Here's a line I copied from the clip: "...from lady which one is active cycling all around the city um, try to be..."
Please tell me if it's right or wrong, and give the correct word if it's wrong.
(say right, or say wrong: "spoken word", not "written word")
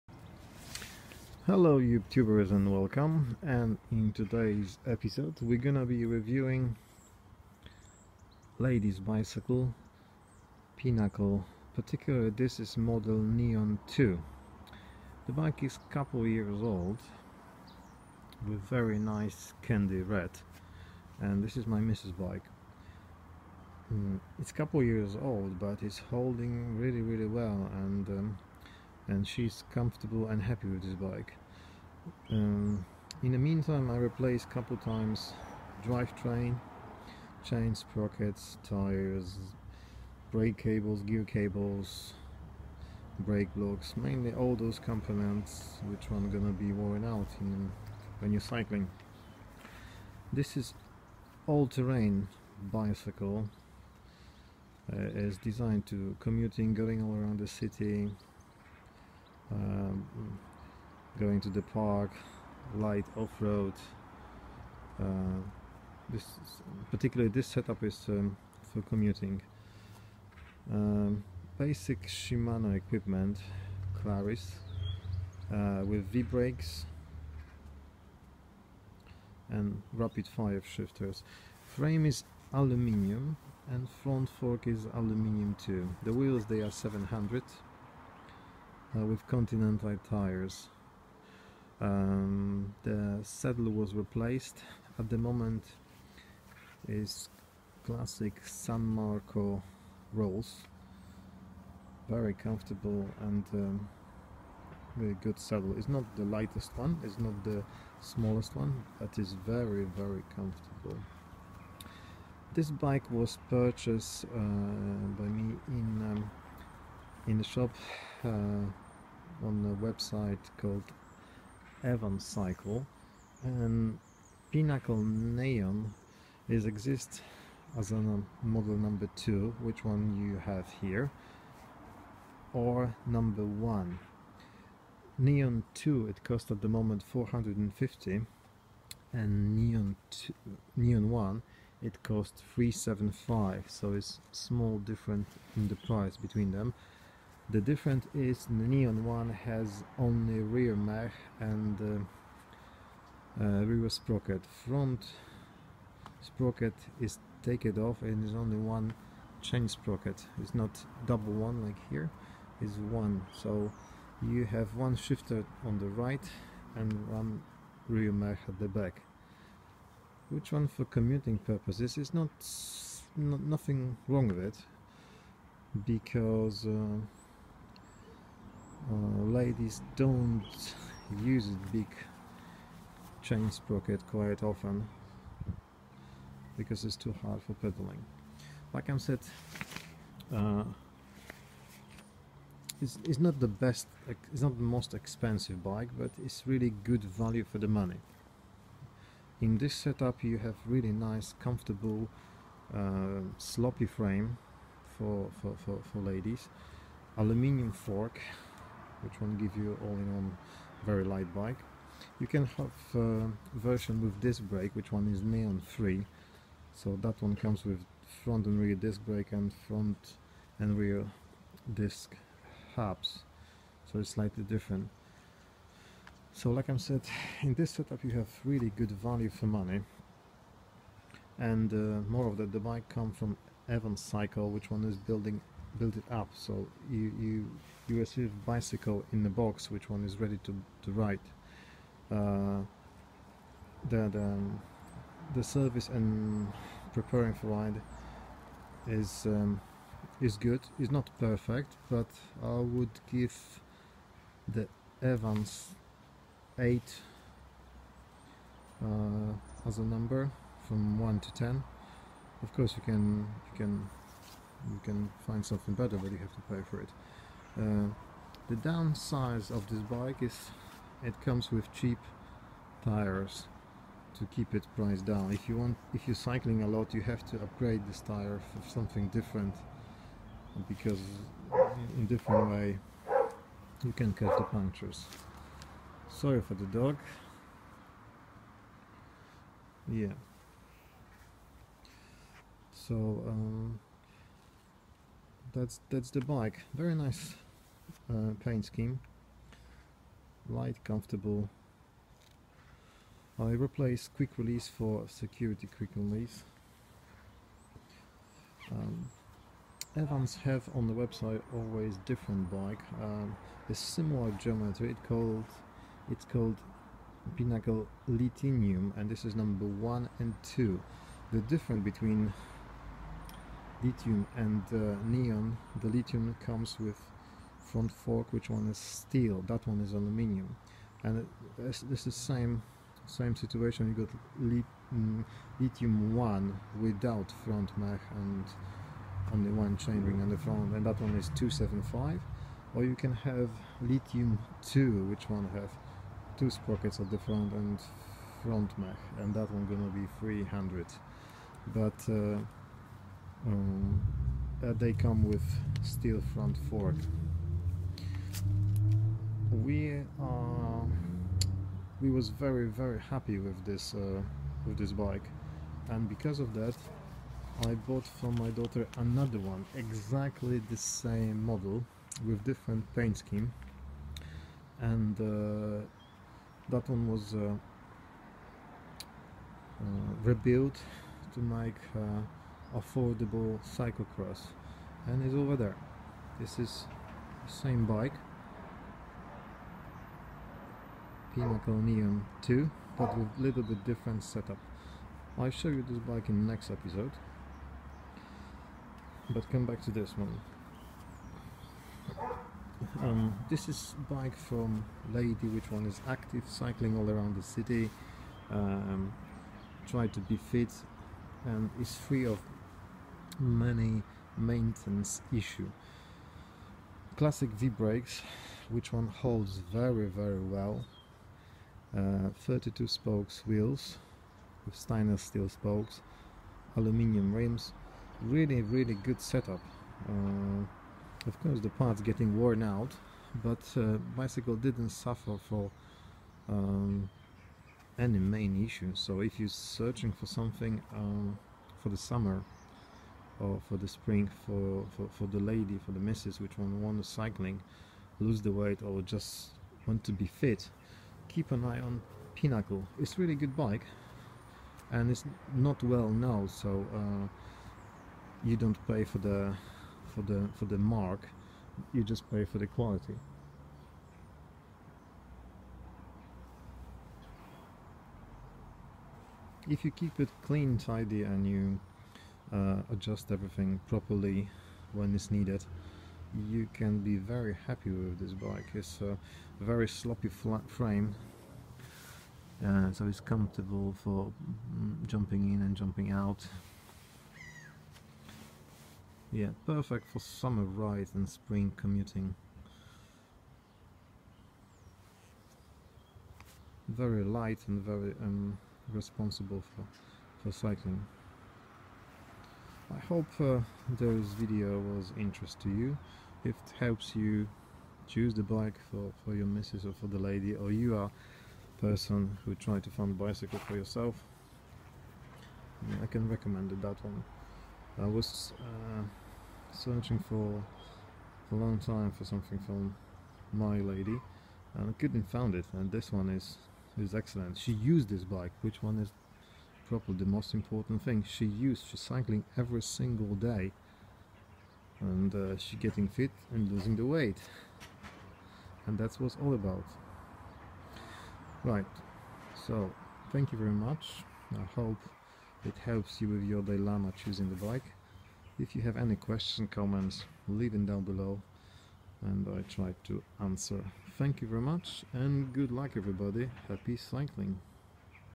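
right.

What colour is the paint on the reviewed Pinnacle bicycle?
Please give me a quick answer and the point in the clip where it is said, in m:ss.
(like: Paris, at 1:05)
Candy red, at 0:19.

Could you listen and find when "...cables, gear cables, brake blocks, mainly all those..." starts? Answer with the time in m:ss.
0:40.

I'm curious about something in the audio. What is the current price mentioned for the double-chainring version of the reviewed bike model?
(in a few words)
450.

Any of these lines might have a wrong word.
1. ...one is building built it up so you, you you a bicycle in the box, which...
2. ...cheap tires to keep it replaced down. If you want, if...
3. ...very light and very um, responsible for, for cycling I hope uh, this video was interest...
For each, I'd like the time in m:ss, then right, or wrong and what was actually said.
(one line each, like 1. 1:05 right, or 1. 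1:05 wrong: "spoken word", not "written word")
1. 3:54 right
2. 4:31 wrong: "priced", not "replaced"
3. 8:16 right.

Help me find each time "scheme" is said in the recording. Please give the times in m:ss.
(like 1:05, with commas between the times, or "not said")
4:58, 6:13.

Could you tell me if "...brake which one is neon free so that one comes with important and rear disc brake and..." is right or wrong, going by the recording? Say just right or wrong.
wrong.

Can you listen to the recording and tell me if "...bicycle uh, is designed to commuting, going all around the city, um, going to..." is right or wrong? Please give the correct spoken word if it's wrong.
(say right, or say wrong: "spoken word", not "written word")
right.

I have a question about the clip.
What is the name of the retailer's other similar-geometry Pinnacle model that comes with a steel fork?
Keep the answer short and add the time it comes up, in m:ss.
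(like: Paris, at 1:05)
Pinnacle Lithium, at 5:17.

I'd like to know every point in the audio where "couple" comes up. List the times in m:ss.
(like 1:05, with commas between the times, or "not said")
0:15, 0:24, 0:34.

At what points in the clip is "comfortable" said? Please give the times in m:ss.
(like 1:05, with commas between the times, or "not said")
0:29, 1:42, 1:50, 3:21, 5:00, 8:03.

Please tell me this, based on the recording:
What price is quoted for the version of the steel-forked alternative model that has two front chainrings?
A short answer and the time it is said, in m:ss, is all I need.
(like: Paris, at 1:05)
300, at 5:50.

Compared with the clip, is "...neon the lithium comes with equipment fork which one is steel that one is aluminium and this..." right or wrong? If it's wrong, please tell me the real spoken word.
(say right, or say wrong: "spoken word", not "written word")
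wrong: "front", not "equipment".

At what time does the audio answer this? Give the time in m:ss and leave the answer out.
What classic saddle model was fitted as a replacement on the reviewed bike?
1:38.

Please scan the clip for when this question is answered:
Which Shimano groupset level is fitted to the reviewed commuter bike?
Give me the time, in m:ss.
1:14.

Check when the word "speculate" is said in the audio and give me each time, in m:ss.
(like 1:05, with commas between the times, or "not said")
not said.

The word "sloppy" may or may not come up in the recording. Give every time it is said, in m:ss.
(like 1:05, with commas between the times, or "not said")
3:23, 7:59.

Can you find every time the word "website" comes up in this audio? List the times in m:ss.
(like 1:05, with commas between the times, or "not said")
1:59, 5:10.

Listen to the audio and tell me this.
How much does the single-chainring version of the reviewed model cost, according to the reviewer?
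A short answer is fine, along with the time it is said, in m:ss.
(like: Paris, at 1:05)
375, at 2:22.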